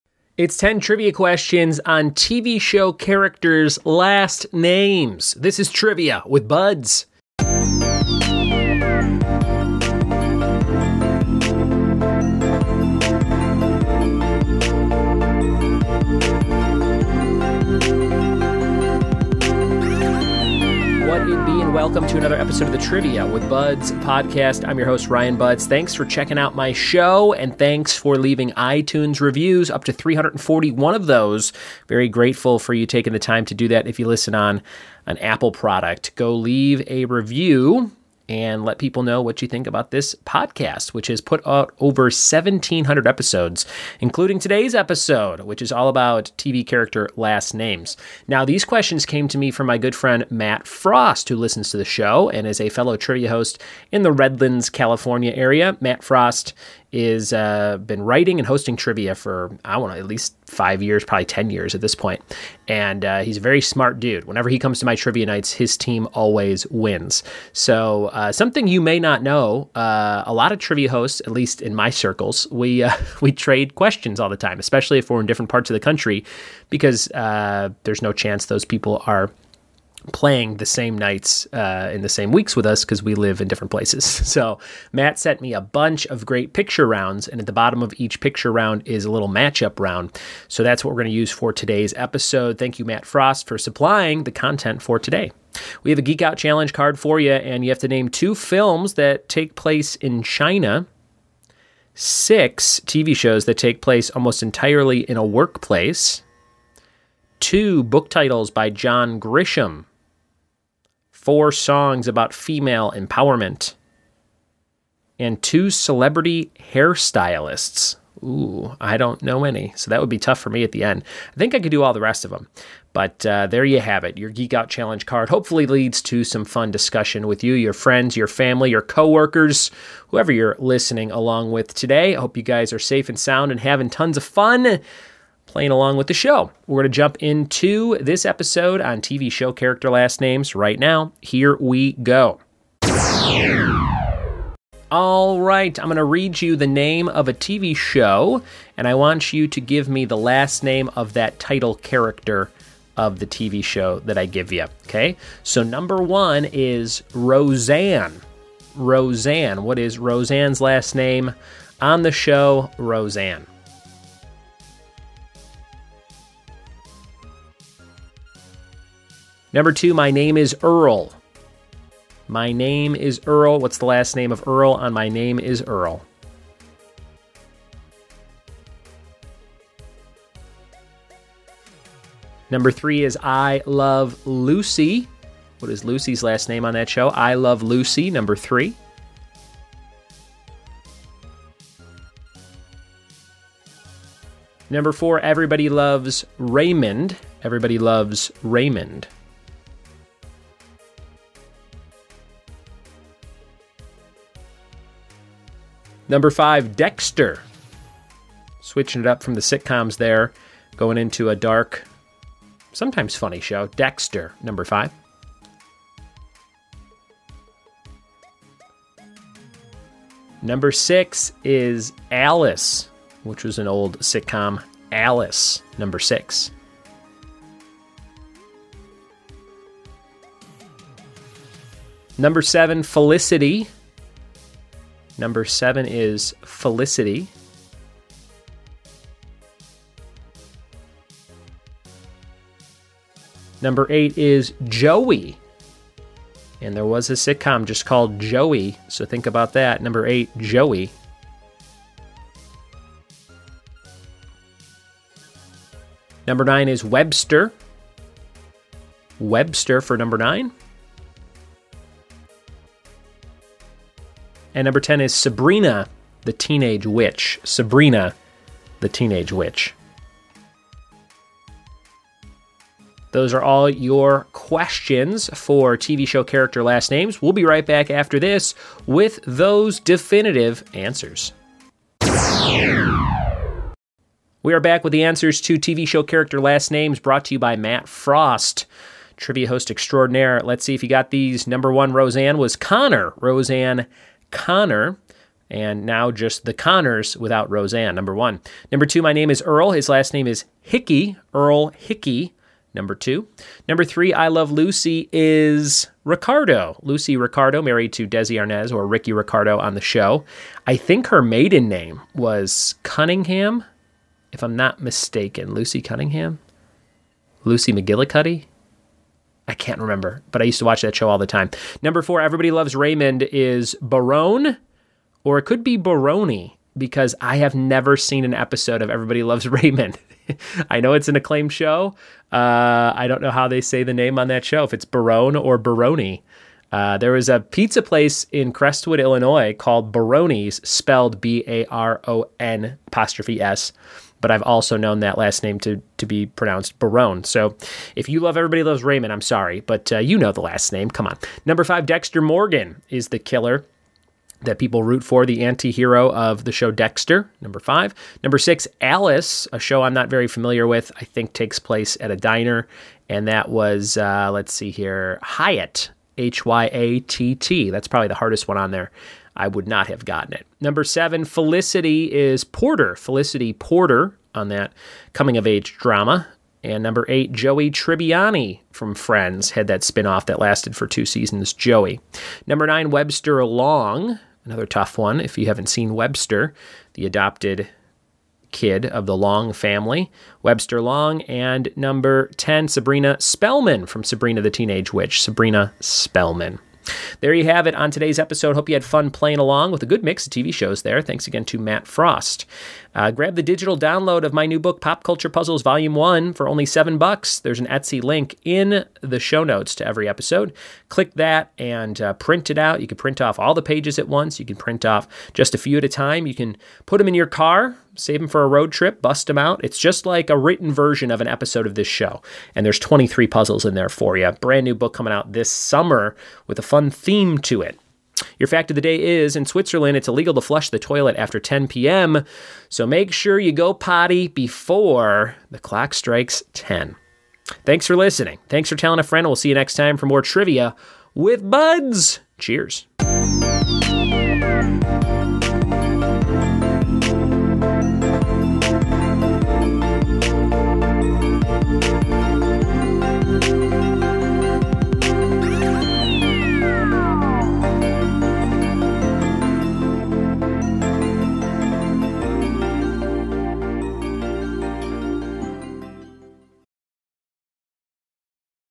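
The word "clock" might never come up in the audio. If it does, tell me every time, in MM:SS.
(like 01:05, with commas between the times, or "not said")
07:15.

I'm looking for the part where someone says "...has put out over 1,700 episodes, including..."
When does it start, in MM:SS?
00:41.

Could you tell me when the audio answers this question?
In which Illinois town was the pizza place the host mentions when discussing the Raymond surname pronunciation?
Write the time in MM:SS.
05:38.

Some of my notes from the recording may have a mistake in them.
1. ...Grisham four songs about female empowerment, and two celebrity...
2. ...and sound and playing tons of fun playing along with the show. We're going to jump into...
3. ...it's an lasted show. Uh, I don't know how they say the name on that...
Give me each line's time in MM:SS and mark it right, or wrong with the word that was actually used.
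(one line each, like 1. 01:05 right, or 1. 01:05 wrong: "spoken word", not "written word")
1. 01:49 right
2. 02:13 wrong: "having", not "playing"
3. 05:30 wrong: "acclaimed", not "lasted".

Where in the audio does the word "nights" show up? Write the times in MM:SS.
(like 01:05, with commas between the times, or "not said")
01:05, 01:20.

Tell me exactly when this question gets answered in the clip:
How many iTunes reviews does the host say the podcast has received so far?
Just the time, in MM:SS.
00:29.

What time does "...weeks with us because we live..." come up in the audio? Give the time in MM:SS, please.
01:22.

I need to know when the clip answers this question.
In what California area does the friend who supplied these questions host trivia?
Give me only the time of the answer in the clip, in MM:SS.
00:54.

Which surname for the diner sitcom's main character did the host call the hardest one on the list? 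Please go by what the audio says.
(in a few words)
Hyatt.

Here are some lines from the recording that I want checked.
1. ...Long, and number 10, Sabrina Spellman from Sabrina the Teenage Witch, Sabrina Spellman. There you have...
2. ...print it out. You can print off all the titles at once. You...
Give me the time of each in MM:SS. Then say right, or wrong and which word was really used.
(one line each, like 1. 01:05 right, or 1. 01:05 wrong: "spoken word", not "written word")
1. 06:30 right
2. 06:52 wrong: "pages", not "titles".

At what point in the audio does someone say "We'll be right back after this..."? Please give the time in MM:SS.
04:37.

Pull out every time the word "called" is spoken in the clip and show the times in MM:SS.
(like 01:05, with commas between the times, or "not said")
04:07, 05:39.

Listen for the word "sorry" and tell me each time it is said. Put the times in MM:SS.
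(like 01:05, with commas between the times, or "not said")
05:49.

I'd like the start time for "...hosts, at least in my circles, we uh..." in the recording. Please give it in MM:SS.
01:10.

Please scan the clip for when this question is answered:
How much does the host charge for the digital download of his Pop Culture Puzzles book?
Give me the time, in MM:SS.
06:46.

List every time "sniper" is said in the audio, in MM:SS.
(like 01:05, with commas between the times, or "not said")
not said.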